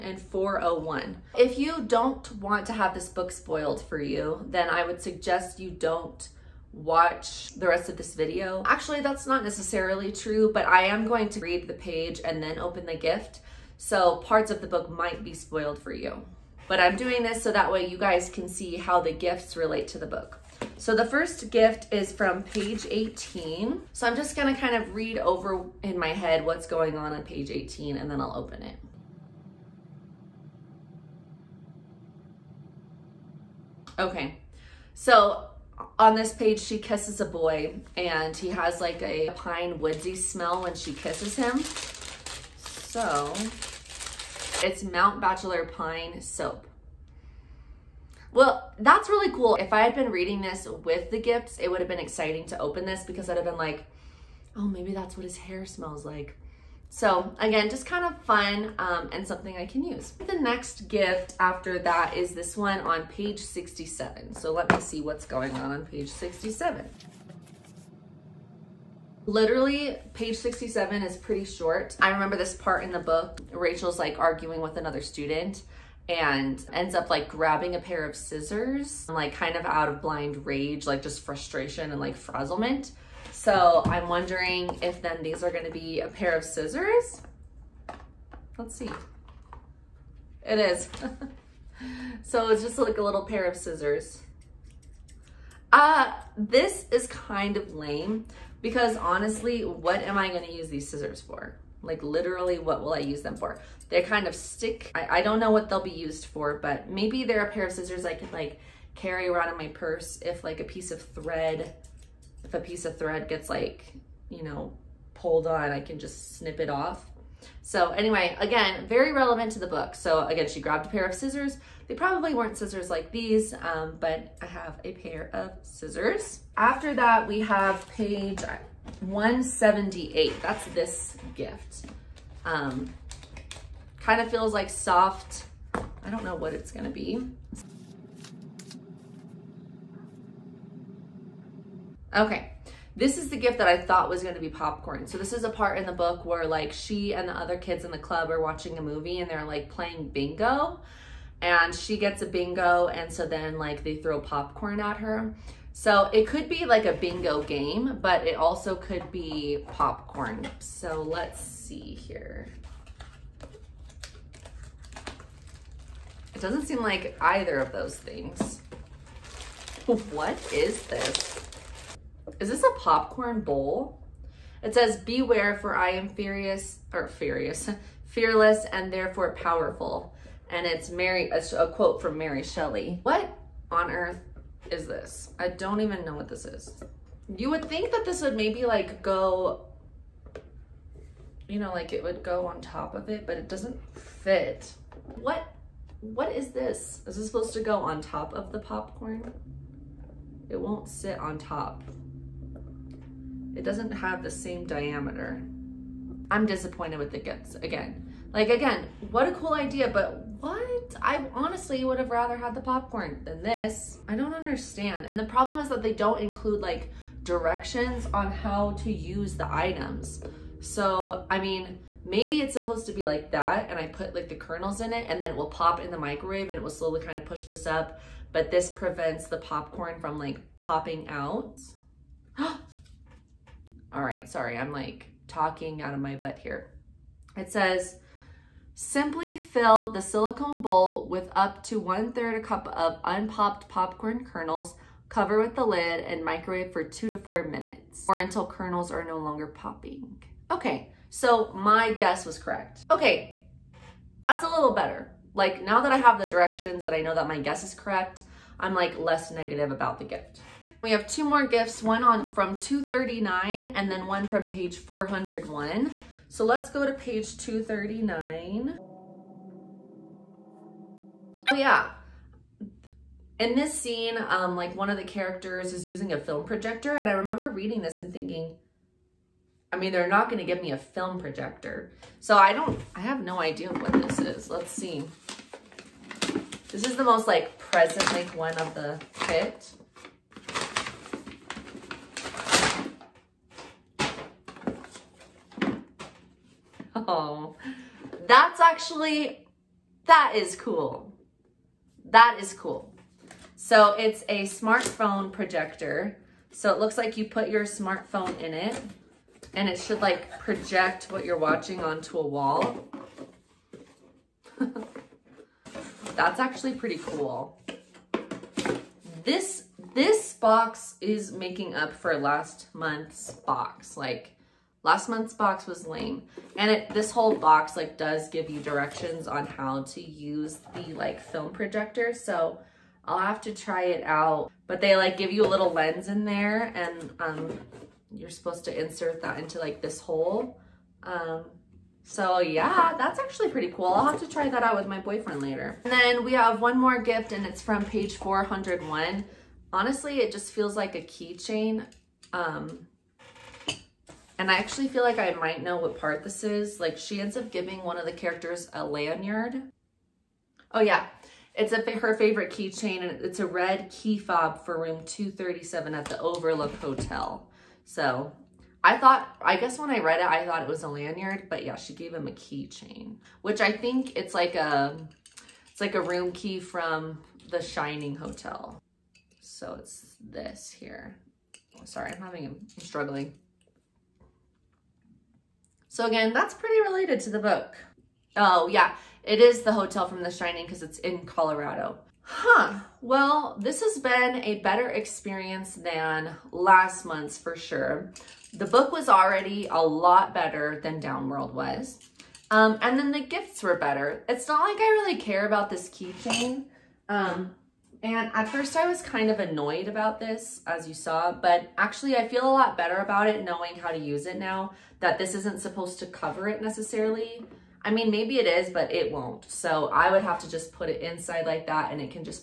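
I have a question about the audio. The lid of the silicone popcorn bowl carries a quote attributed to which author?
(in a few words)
Mary Shelley.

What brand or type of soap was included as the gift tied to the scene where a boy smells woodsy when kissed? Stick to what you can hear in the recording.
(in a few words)
Mount Bachelor Pine Soap.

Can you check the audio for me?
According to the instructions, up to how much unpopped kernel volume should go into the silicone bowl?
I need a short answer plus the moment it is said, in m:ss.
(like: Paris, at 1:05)
one third a cup, at 4:01.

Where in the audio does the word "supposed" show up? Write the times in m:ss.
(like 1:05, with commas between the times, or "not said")
3:17, 3:42, 5:38, 6:55.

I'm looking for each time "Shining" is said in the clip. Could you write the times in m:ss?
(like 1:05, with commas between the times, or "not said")
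6:17, 6:30.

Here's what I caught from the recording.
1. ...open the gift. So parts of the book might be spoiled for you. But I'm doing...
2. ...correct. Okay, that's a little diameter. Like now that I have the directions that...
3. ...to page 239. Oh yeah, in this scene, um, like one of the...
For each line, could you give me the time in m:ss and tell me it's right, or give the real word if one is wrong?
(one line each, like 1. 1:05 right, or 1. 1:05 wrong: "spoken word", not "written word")
1. 0:12 right
2. 4:12 wrong: "better", not "diameter"
3. 4:26 right.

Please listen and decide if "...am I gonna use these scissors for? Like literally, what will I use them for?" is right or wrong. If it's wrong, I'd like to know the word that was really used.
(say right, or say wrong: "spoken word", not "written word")
right.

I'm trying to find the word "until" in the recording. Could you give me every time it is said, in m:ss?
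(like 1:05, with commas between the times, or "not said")
4:08.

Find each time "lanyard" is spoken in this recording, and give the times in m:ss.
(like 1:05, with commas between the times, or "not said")
5:58, 6:10.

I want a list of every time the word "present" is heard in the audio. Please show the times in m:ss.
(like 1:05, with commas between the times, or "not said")
4:47.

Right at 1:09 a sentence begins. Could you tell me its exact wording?
Literally, page 67 is pretty short.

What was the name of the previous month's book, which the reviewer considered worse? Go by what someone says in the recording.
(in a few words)
Downworld.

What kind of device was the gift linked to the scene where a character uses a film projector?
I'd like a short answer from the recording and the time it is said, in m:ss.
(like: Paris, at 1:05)
smartphone projector, at 5:04.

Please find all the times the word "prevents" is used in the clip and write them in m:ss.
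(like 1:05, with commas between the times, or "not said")
3:48.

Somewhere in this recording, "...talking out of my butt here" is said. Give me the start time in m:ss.
3:55.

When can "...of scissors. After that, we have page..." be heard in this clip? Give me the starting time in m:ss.
2:05.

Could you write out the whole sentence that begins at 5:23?
Like Last month's box was lame.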